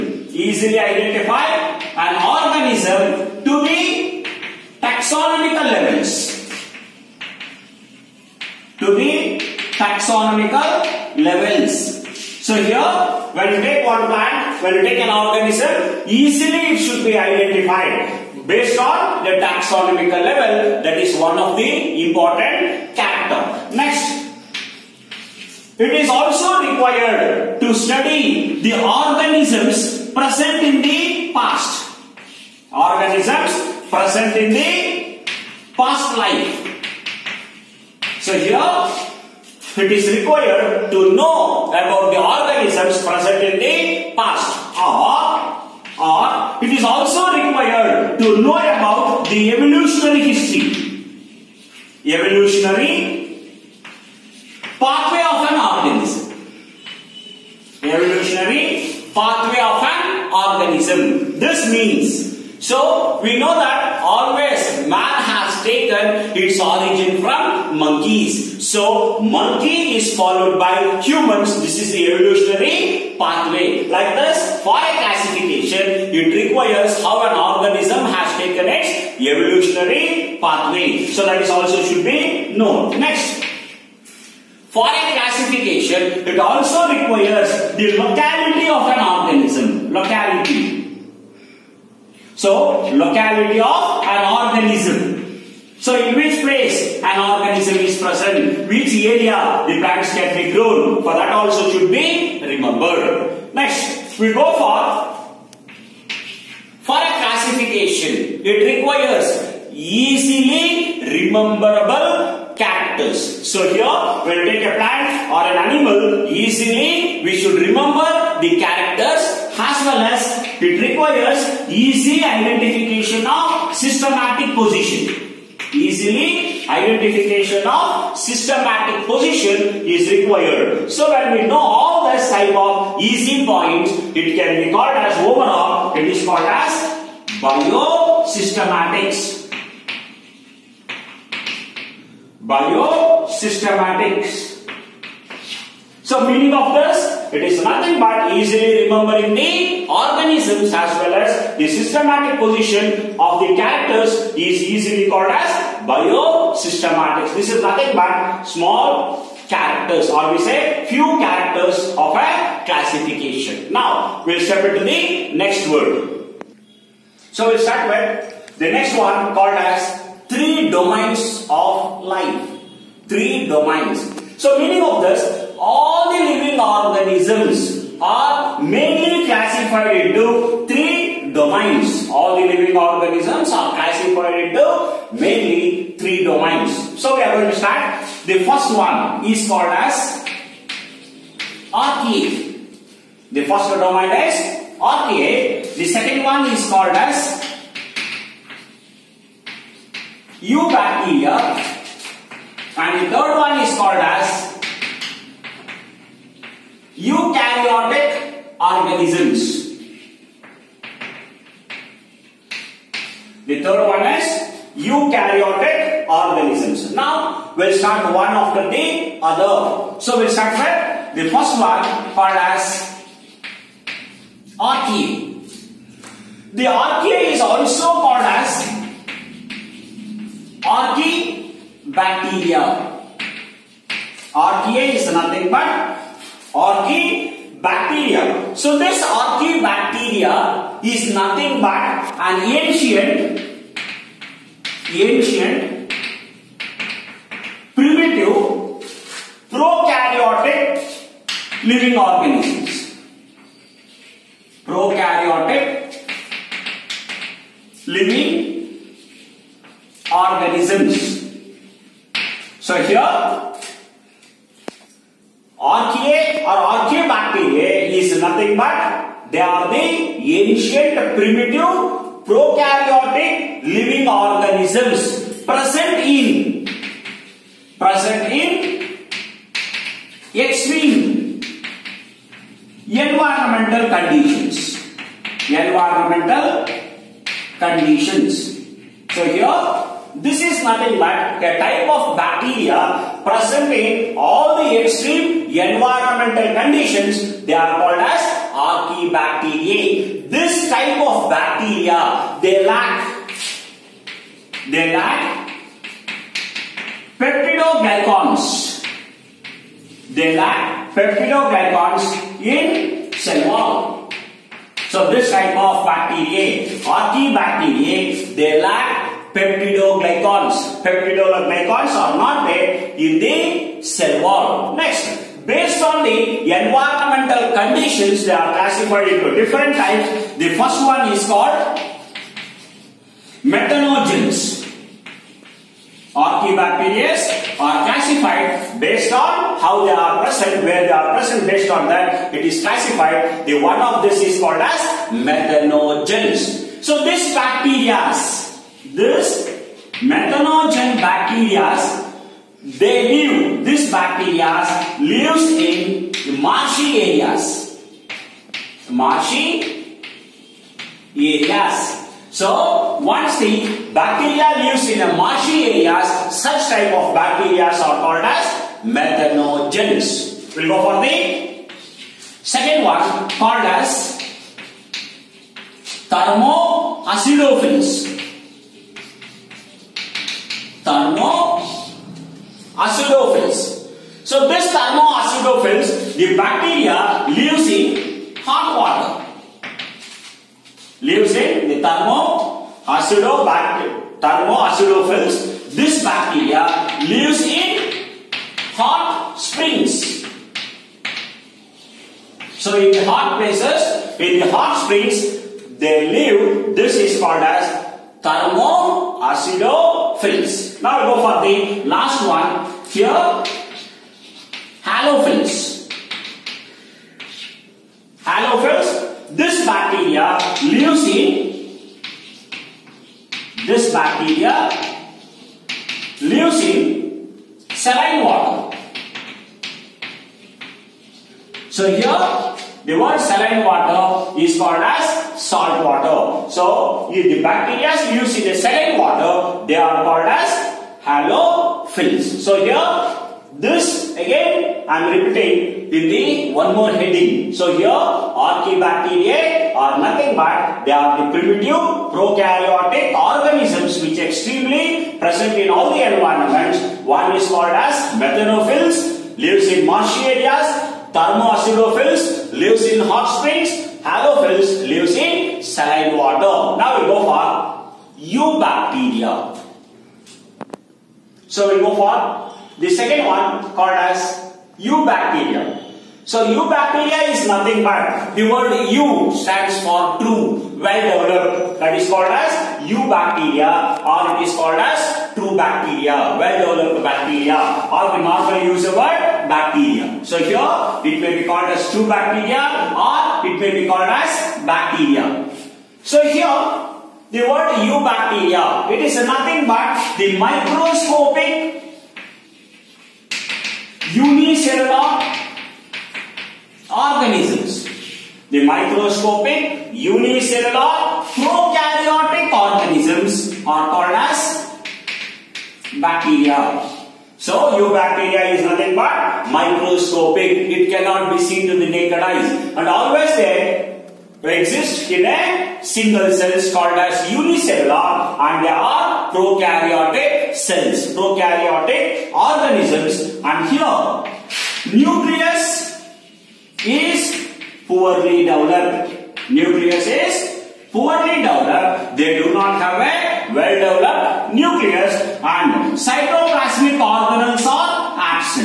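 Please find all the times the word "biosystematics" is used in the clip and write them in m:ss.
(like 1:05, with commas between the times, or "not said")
2:17, 2:22, 2:35.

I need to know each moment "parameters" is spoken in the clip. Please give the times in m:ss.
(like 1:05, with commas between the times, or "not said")
not said.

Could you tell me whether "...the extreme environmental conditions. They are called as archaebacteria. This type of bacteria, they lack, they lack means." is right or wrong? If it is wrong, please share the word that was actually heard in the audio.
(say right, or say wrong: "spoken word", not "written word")
wrong: "peptidoglycans", not "means".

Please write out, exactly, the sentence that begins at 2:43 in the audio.
Now, we'll step into the next word.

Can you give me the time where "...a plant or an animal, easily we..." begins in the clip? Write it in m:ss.
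1:54.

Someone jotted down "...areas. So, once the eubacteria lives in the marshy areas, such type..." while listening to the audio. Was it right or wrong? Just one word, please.
wrong.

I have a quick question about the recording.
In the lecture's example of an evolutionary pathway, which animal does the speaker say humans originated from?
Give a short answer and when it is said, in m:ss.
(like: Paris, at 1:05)
Monkeys, at 1:07.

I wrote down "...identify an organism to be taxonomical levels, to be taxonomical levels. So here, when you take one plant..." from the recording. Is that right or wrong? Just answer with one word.
right.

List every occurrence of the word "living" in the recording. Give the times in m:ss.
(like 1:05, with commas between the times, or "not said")
2:56, 3:02, 4:11, 4:17, 4:33.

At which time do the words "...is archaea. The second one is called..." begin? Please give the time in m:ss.
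3:14.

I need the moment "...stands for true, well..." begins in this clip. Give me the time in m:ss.
7:59.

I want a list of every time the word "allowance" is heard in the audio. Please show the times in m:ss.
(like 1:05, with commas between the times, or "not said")
not said.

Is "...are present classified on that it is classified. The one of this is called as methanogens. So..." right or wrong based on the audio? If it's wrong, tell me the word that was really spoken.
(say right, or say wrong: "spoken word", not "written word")
wrong: "based", not "classified".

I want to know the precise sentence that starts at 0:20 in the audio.
That is one of the important character.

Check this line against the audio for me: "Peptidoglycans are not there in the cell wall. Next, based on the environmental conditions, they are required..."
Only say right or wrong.
wrong.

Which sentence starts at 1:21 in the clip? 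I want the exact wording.
So, that is also should be known.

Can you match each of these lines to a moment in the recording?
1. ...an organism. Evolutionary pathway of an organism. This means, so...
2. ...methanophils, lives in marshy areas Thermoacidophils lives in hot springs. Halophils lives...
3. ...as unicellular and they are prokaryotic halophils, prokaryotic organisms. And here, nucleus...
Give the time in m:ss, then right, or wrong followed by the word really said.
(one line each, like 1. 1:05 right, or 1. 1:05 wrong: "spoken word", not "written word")
1. 0:55 right
2. 7:38 right
3. 8:46 wrong: "cells", not "halophils".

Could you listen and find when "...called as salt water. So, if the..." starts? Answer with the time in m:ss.
7:14.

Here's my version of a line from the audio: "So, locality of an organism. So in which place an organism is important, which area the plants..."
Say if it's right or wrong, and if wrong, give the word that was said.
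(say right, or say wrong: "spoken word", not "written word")
wrong: "present", not "important".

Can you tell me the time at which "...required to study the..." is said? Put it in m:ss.
0:26.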